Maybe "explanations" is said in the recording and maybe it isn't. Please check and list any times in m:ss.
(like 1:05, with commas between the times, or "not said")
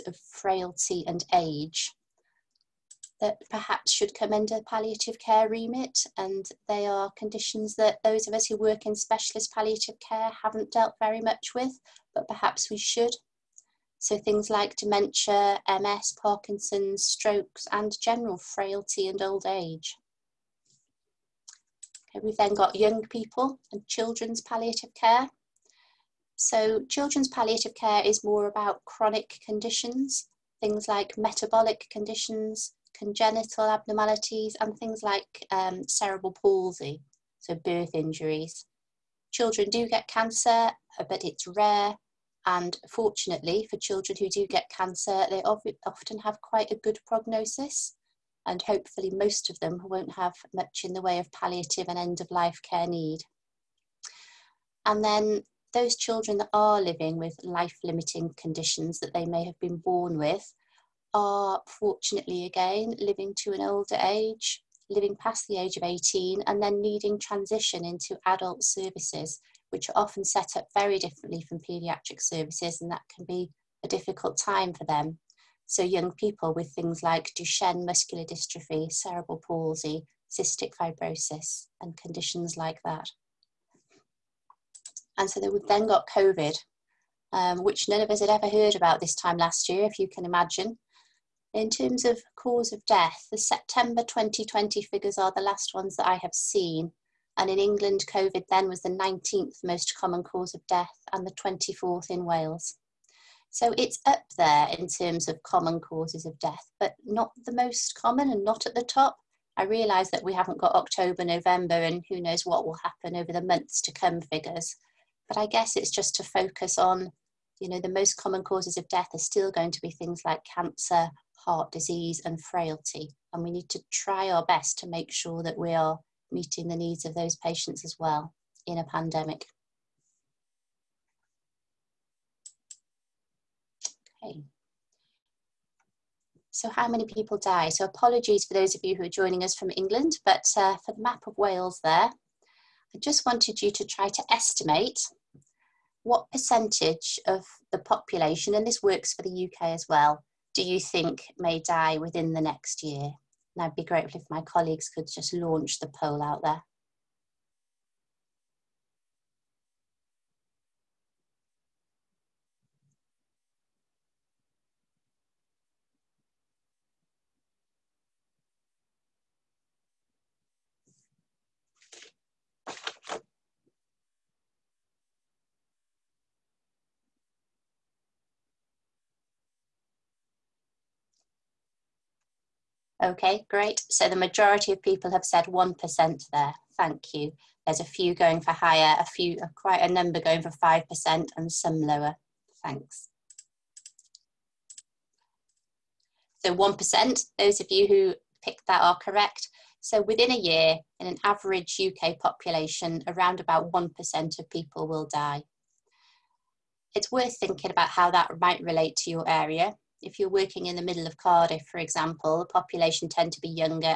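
not said.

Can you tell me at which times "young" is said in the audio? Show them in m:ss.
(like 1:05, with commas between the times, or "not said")
0:22, 1:15.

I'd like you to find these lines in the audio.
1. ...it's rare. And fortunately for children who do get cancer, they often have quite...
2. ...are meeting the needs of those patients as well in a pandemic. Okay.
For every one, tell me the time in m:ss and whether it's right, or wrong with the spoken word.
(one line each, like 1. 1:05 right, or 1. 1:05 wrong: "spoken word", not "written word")
1. 0:41 right
2. 2:05 right.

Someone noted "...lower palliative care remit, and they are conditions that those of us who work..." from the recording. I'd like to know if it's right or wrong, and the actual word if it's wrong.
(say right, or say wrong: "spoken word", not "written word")
wrong: "under", not "lower".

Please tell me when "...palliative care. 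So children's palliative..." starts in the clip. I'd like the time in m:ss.
0:24.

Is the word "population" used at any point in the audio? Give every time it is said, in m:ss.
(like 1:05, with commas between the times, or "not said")
2:27, 3:22, 3:32.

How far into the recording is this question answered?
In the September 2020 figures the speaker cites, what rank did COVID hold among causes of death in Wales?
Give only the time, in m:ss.
1:41.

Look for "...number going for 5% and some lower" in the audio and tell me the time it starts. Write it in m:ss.
3:09.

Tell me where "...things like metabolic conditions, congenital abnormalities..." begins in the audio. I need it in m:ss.
0:30.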